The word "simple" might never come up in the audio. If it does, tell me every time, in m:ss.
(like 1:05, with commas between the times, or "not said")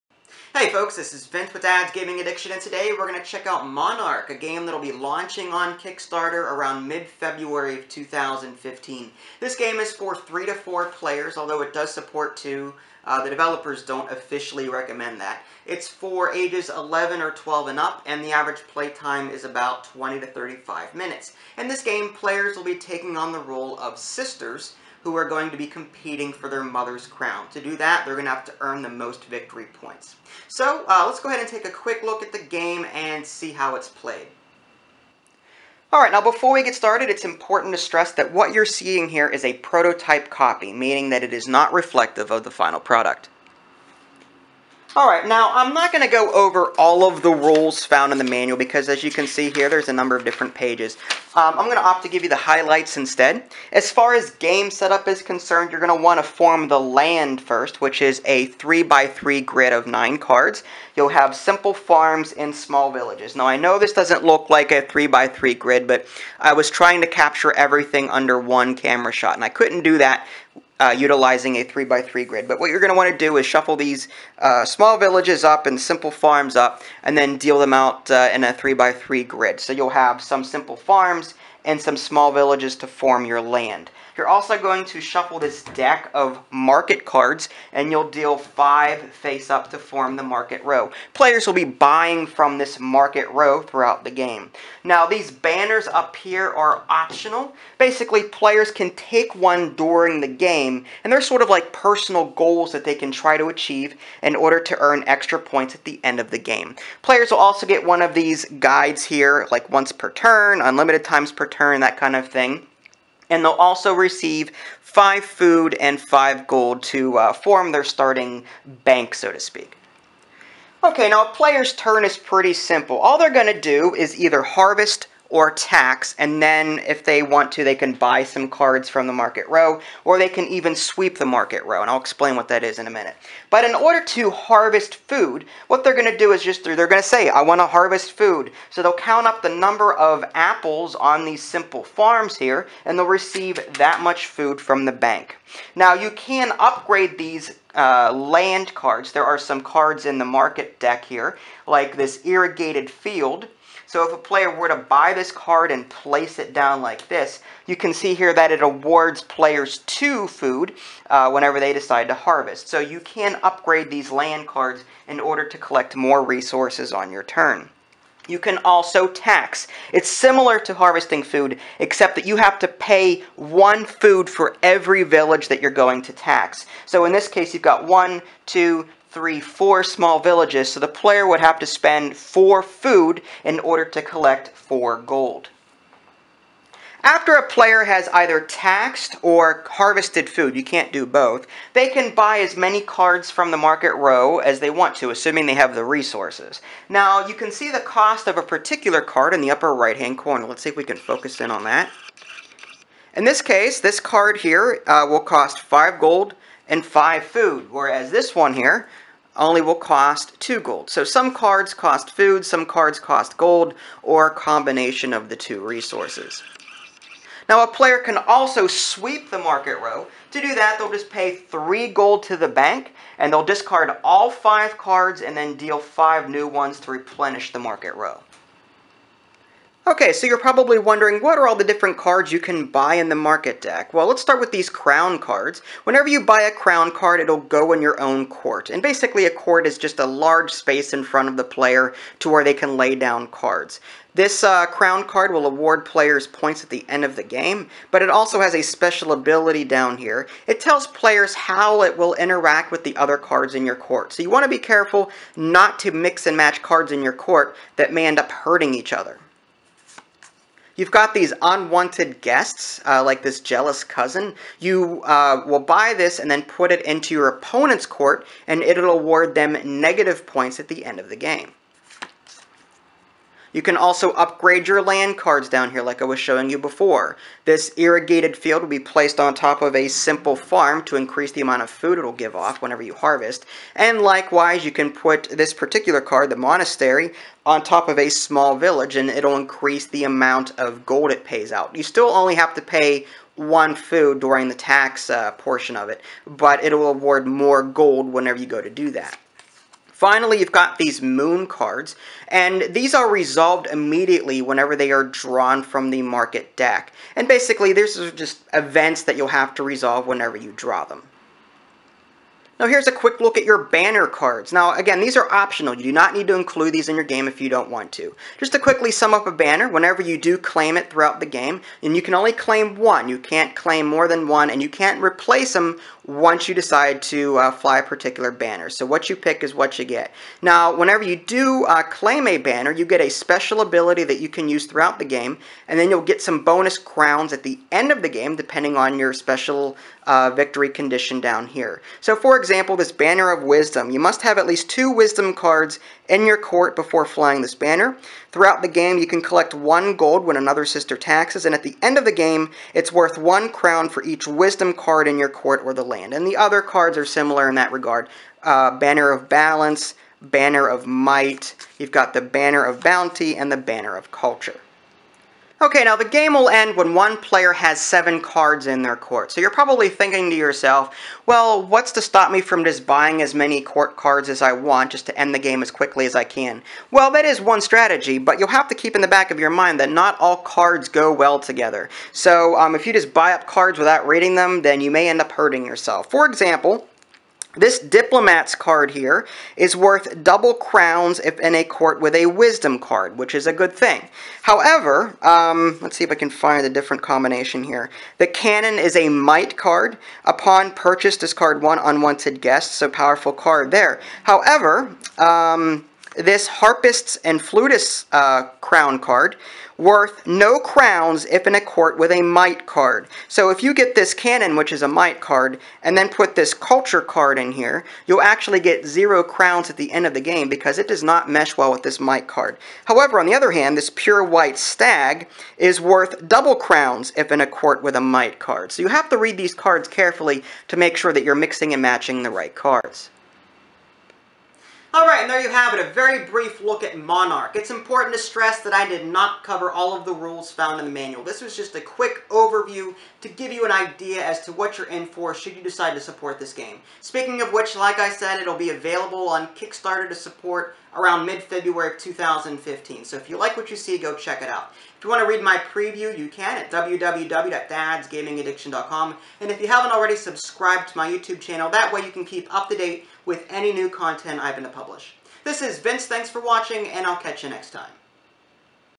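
1:01, 1:15, 1:20, 2:02, 2:21, 4:39.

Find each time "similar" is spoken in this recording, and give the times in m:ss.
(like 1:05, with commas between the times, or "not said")
2:50, 5:57.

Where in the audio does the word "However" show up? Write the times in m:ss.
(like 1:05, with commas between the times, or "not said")
6:34, 6:44, 7:02.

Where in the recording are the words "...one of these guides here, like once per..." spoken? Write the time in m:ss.
1:47.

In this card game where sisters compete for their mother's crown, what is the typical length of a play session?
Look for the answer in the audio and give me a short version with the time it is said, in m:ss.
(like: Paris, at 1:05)
20 to 35 minutes, at 0:19.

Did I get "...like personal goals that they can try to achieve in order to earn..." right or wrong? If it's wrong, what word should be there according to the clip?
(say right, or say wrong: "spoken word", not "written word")
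right.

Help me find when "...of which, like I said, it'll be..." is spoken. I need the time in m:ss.
7:27.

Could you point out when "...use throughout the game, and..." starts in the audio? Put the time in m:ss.
5:34.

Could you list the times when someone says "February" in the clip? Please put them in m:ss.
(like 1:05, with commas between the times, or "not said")
0:06, 7:31.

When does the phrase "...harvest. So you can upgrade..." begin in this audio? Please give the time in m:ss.
2:42.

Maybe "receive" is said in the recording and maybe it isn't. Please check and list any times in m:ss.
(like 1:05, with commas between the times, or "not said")
1:53, 2:23.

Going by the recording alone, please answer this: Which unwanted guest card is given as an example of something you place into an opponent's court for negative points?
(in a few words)
Jealous cousin.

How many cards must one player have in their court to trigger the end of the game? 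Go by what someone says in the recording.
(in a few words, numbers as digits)
7.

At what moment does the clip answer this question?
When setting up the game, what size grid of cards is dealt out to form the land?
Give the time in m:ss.
0:58.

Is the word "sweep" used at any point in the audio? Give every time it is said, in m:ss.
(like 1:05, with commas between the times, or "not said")
2:10, 3:38.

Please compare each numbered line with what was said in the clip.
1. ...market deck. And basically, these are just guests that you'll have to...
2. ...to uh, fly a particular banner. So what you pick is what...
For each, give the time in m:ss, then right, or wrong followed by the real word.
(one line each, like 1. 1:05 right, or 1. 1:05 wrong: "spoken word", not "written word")
1. 5:06 wrong: "events", not "guests"
2. 5:27 right.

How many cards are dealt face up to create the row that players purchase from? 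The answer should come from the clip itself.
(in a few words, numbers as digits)
5.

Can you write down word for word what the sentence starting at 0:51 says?
Um, I'm going to opt to give you the highlights instead.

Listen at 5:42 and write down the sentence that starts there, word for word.
So for example, this Banner of Wisdom.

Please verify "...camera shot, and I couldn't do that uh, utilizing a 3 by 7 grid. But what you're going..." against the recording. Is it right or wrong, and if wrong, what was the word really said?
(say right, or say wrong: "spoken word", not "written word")
wrong: "3", not "7".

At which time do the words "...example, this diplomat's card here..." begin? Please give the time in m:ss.
6:26.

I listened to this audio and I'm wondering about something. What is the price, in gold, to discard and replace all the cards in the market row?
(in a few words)
3 gold.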